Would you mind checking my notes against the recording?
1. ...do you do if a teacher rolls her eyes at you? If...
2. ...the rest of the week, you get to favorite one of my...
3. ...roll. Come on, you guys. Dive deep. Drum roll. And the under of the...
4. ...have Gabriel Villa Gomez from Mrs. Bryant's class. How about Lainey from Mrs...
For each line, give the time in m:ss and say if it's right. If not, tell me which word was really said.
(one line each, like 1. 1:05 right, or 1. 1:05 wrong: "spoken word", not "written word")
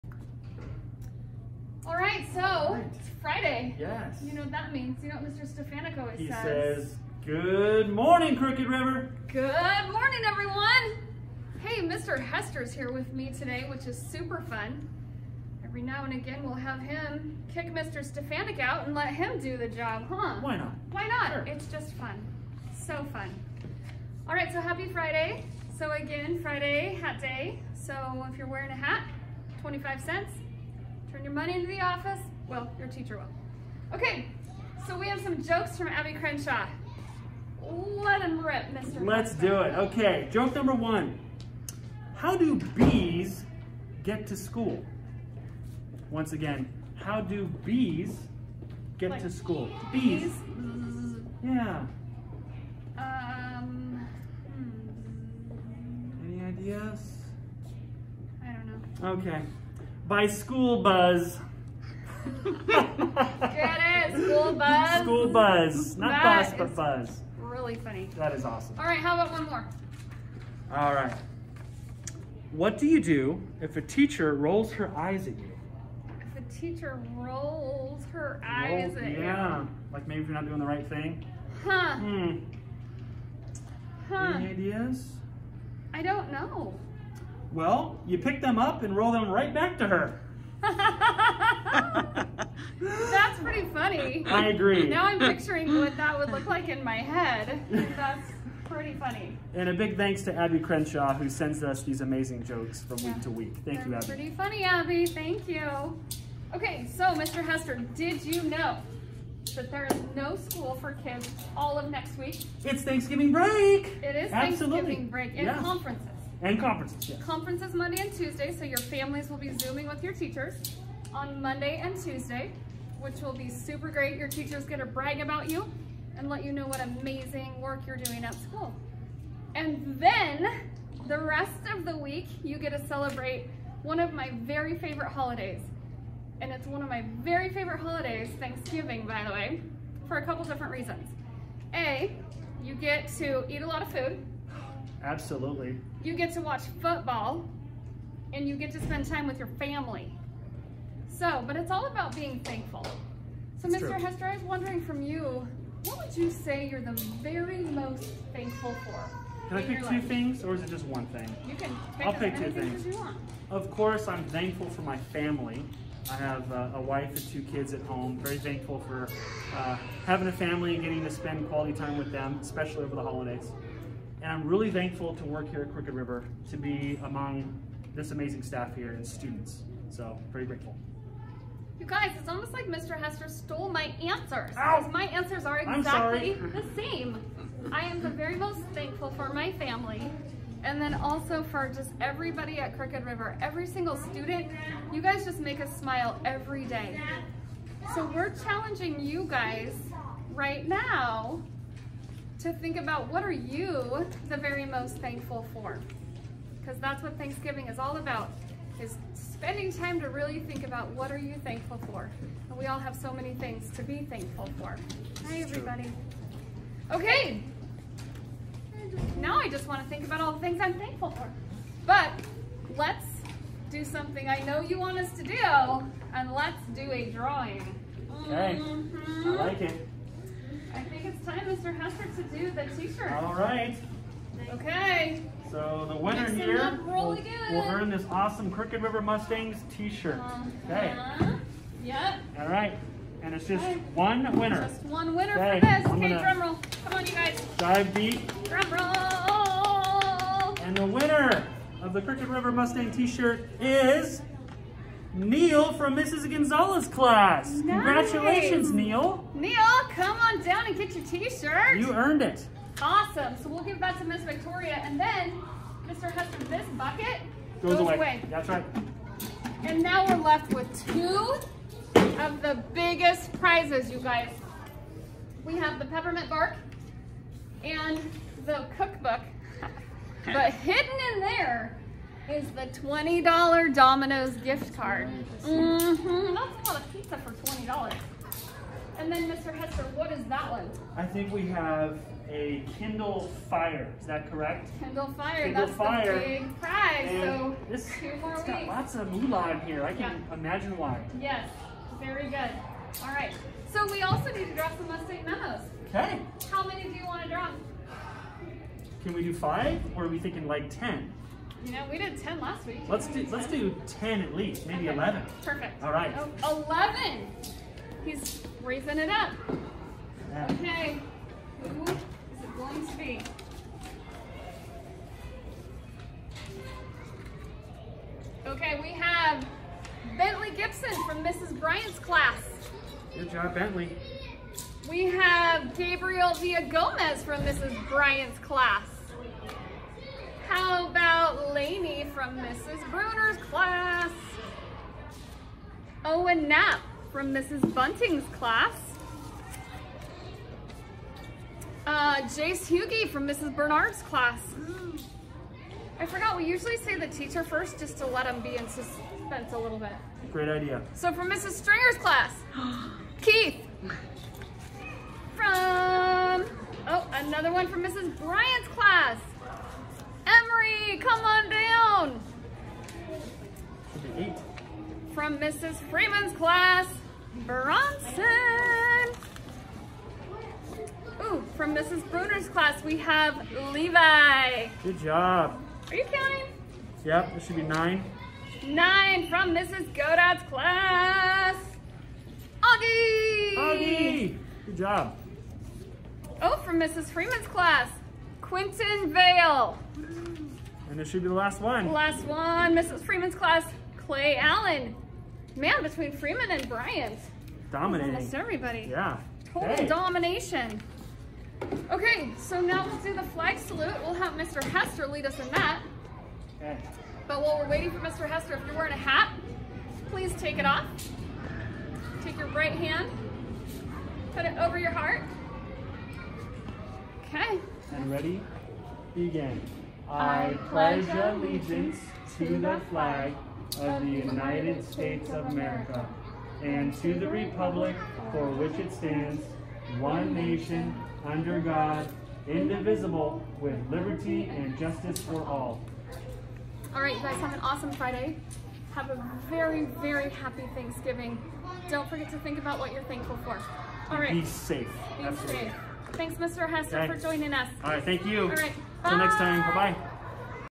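1. 1:12 right
2. 2:11 wrong: "celebrate", not "favorite"
3. 4:06 wrong: "winner", not "under"
4. 5:35 right.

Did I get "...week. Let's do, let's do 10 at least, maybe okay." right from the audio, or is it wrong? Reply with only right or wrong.
right.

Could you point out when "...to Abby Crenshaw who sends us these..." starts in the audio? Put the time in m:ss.
1:40.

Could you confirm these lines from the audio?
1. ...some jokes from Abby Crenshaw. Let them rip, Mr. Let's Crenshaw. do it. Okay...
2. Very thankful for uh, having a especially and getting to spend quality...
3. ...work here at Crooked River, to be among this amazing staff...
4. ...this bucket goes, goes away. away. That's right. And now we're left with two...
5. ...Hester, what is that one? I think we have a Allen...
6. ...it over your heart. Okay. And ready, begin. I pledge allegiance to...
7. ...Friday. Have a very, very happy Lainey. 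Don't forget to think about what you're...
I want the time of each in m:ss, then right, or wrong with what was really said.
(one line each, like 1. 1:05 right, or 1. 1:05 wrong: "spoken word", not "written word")
1. 0:35 right
2. 2:48 wrong: "family", not "especially"
3. 2:55 right
4. 4:26 right
5. 4:49 wrong: "Kindle", not "Allen"
6. 7:04 right
7. 7:27 wrong: "Thanksgiving", not "Lainey".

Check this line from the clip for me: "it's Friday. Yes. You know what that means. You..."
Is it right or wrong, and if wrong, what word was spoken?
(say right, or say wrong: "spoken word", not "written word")
right.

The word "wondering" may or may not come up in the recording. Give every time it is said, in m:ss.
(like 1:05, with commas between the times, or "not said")
2:34.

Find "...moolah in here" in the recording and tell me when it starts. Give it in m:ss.
4:59.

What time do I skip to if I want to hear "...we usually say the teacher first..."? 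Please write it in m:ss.
5:56.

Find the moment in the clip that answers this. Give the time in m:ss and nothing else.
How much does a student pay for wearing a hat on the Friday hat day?
0:29.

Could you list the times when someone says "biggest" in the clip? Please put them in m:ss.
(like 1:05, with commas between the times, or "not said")
4:32.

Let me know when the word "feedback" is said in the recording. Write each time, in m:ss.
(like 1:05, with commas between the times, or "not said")
not said.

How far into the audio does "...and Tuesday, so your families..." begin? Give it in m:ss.
1:58.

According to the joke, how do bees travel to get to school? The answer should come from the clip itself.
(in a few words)
By school buzz.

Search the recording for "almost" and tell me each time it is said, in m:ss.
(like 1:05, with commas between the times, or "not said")
3:02, 6:48.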